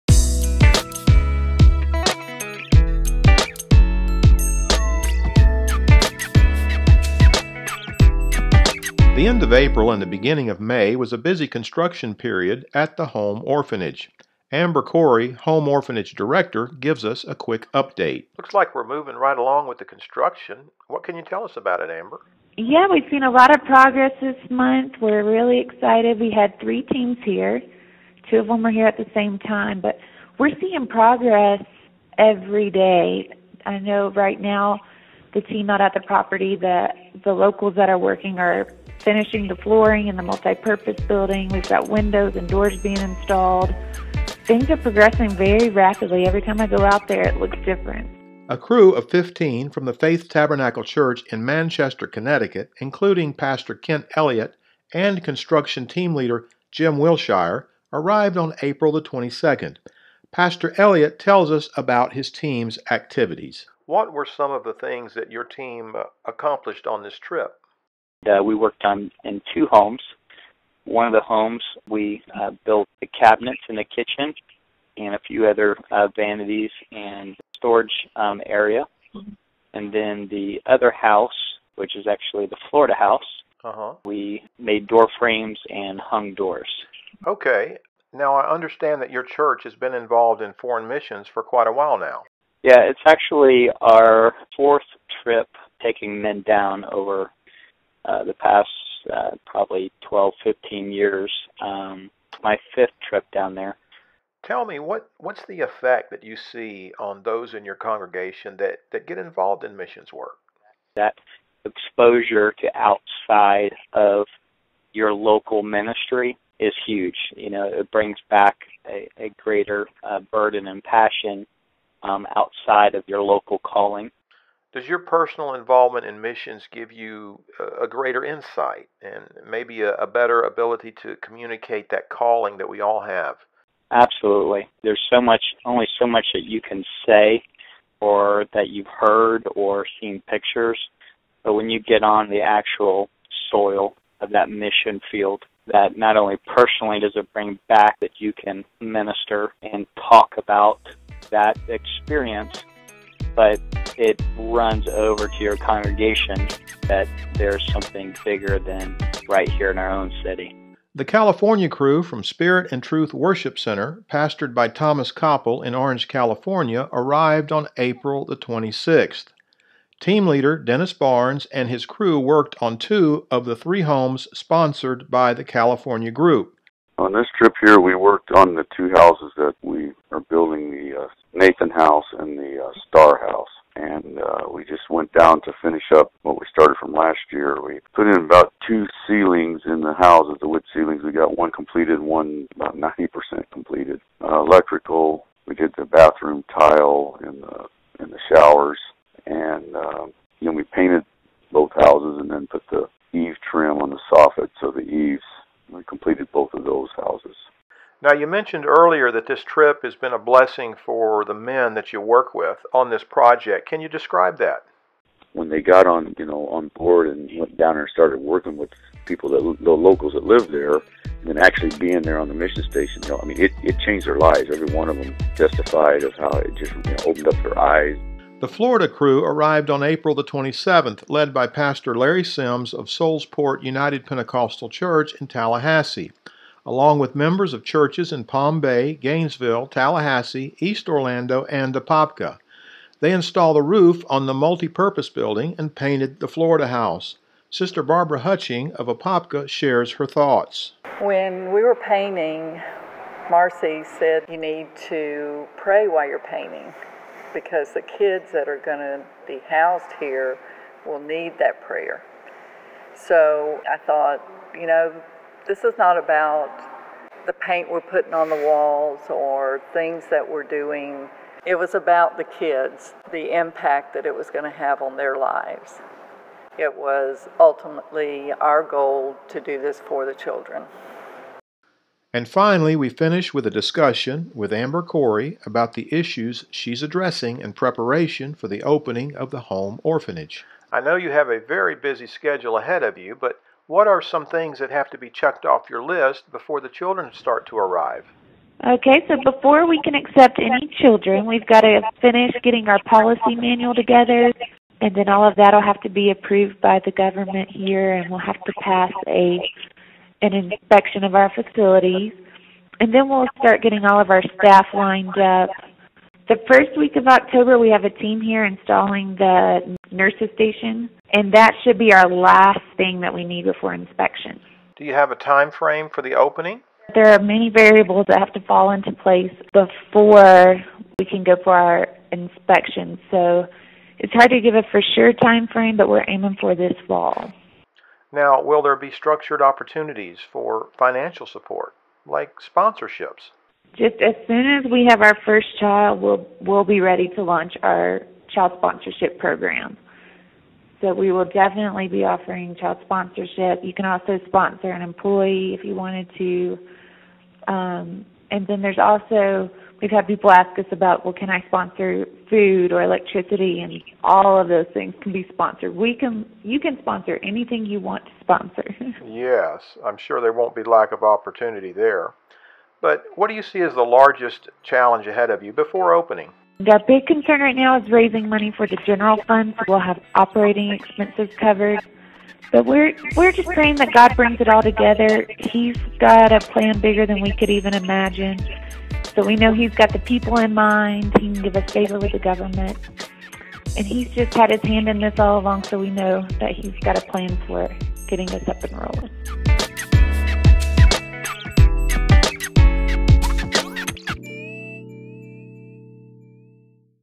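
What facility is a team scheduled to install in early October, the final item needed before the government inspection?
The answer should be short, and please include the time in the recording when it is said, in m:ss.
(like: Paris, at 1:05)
nurses station, at 5:19.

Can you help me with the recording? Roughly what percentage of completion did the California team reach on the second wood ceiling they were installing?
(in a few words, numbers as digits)
90%.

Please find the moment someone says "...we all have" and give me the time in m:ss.
2:12.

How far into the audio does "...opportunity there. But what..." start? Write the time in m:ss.
6:11.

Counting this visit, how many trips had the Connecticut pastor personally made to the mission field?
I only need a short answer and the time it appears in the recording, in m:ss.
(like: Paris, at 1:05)
fifth, at 1:42.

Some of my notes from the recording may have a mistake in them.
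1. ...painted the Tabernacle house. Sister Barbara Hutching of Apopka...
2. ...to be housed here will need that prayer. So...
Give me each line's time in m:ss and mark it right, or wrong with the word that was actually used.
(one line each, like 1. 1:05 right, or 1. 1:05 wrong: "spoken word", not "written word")
1. 4:05 wrong: "Florida", not "Tabernacle"
2. 4:18 right.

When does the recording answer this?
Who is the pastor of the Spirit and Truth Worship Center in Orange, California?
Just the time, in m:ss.
2:44.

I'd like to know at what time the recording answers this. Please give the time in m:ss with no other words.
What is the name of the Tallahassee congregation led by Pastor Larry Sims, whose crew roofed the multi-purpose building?
3:52.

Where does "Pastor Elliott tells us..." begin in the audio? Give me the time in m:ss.
1:00.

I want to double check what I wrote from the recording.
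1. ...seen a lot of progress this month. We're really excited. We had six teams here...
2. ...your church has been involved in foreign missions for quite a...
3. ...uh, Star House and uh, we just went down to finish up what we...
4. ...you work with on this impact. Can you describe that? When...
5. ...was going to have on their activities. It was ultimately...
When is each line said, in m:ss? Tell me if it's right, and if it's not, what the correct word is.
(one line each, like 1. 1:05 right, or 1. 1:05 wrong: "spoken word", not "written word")
1. 0:23 wrong: "three", not "six"
2. 1:29 right
3. 3:02 right
4. 3:31 wrong: "project", not "impact"
5. 4:34 wrong: "lives", not "activities".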